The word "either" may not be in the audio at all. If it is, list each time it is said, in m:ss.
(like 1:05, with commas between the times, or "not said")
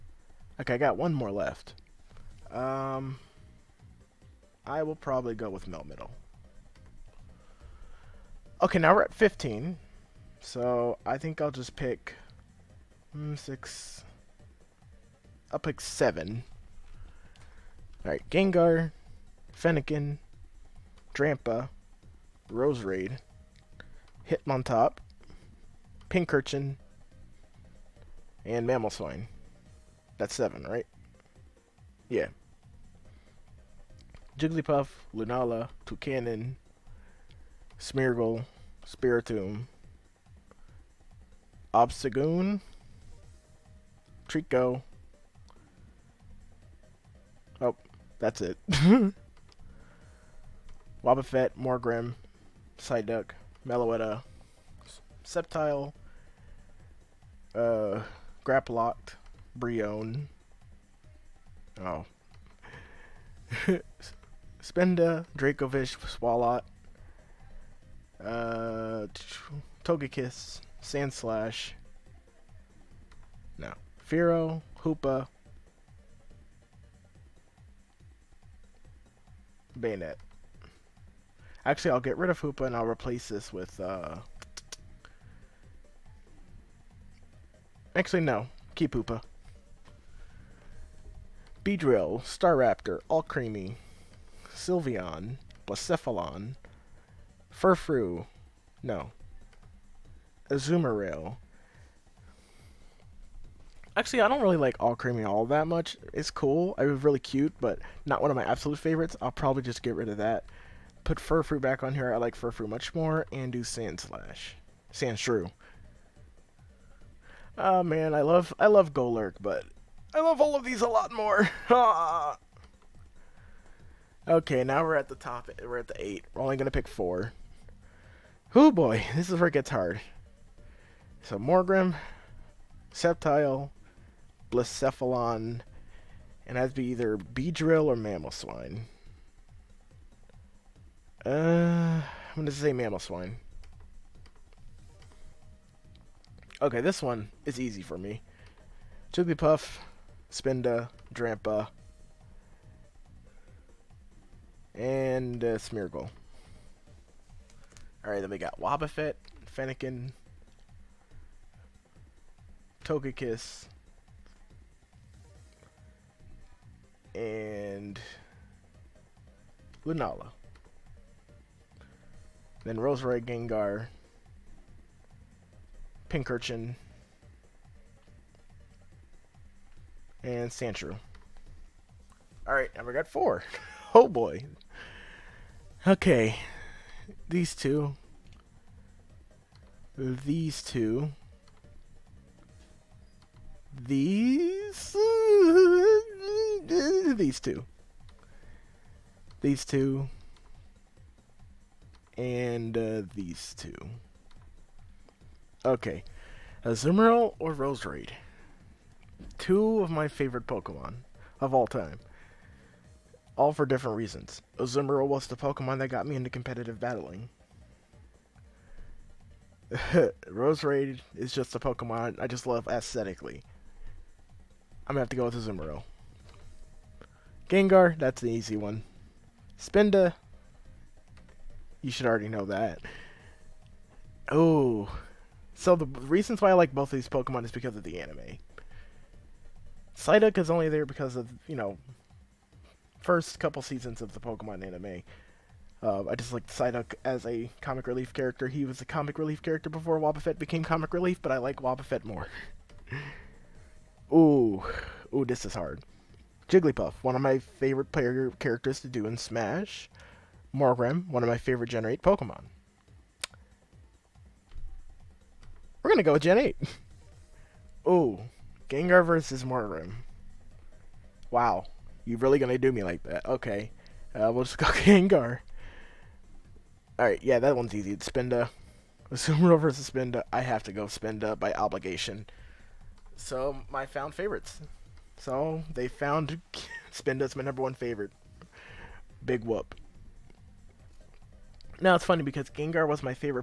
2:16.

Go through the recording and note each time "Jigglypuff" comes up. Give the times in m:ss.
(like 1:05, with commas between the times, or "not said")
0:34, 4:16.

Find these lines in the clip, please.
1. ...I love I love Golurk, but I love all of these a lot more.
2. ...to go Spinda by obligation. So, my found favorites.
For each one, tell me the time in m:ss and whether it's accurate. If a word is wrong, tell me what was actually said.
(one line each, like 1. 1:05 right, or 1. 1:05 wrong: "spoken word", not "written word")
1. 1:58 right
2. 4:40 right.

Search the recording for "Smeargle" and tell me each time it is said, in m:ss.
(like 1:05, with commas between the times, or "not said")
0:37, 2:35.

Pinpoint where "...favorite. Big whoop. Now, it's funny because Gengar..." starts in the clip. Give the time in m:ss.
4:47.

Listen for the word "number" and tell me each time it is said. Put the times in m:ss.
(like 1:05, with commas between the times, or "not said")
4:47.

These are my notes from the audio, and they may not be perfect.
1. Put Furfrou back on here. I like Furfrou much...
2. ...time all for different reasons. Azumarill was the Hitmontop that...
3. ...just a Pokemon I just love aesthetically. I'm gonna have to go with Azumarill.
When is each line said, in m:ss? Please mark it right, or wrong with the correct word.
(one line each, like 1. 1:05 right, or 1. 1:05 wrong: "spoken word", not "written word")
1. 1:51 right
2. 3:31 wrong: "Pokemon", not "Hitmontop"
3. 3:41 right.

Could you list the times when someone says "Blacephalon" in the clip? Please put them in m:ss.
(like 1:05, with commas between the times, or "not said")
1:35, 2:14.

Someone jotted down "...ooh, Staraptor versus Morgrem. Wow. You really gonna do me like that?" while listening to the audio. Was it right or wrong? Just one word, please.
wrong.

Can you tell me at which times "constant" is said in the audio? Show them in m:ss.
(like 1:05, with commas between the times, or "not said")
not said.